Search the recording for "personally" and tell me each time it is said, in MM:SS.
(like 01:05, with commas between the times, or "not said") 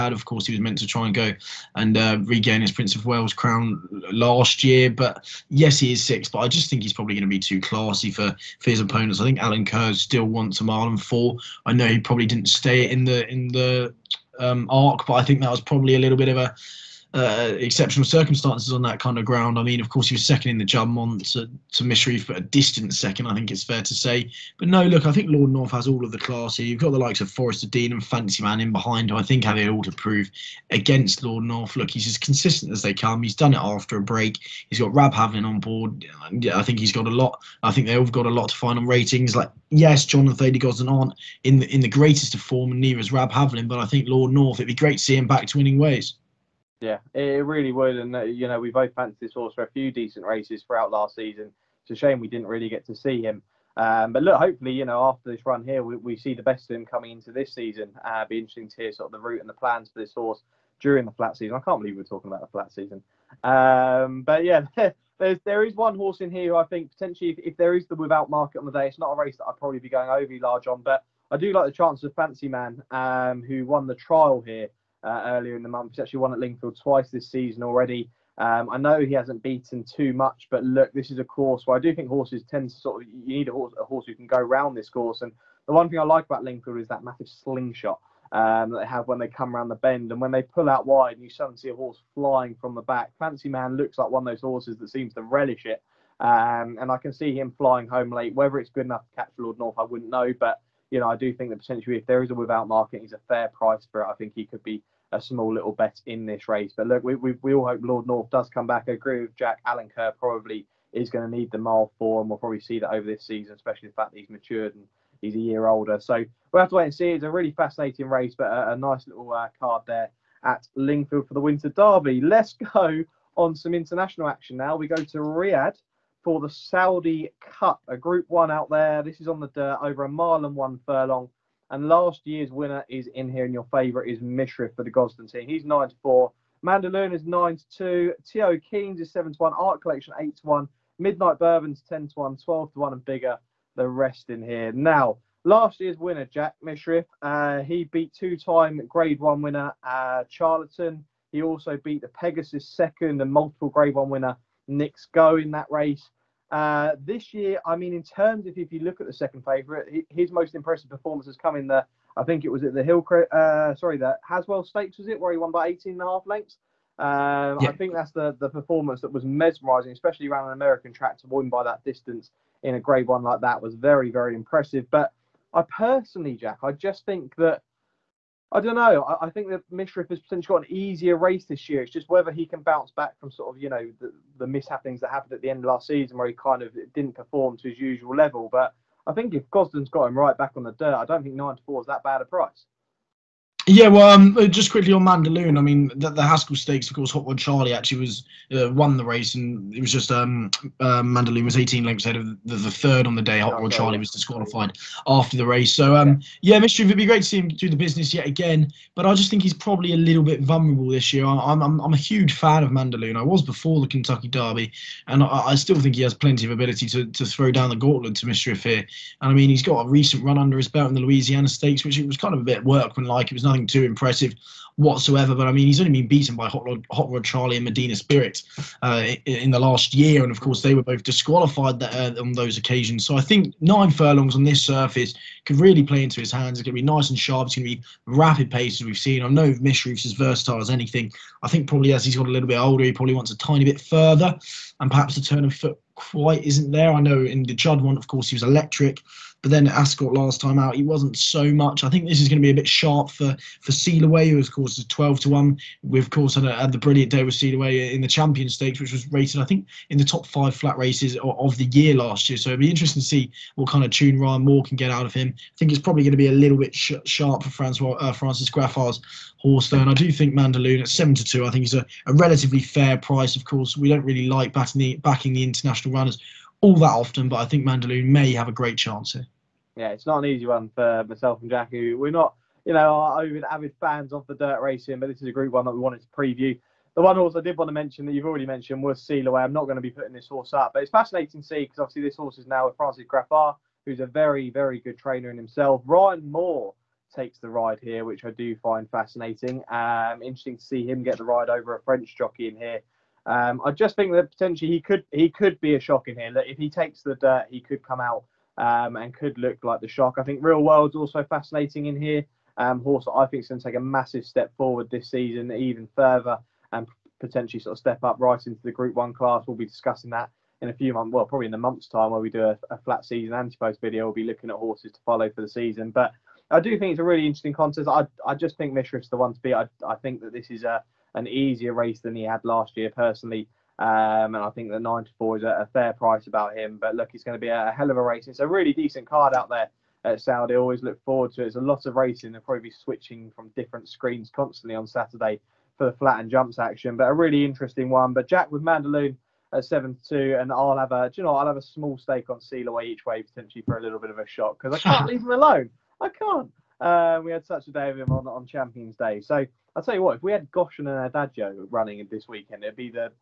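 02:55, 05:32.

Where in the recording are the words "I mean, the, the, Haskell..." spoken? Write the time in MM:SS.
03:15.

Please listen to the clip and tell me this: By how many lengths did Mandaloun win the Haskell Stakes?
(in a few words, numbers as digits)
18 and a half.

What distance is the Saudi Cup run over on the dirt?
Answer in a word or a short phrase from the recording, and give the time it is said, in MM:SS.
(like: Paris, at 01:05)
A mile and one furlong, at 02:10.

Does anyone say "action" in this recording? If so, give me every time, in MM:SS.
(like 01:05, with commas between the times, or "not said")
02:04, 05:46.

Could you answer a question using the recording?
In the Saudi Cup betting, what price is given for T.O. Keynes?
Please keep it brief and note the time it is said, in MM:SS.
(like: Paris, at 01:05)
7/1, at 02:19.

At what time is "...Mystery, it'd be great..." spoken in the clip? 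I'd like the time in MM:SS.
03:26.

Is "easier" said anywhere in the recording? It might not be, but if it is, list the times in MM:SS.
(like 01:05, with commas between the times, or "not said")
03:00, 05:31.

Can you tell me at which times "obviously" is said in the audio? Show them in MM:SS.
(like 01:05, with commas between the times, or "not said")
04:51.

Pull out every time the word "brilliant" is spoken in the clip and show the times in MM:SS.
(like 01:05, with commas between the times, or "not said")
04:16.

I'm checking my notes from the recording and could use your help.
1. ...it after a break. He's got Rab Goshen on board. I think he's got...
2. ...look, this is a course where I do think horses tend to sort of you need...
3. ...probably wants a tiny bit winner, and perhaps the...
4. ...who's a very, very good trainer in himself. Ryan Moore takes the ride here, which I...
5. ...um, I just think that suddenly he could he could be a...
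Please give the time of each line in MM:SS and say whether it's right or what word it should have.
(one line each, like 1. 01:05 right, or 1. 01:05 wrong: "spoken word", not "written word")
1. 00:33 wrong: "Havlin", not "Goshen"
2. 01:20 right
3. 04:02 wrong: "further", not "winner"
4. 04:53 right
5. 05:03 wrong: "potentially", not "suddenly".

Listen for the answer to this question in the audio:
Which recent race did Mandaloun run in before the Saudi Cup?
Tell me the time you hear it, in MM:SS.
03:41.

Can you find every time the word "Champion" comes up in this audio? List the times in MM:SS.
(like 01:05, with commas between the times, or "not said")
04:18, 05:58.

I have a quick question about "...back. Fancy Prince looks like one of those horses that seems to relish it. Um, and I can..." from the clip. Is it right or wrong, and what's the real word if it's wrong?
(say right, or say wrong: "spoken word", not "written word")
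wrong: "Man", not "Prince".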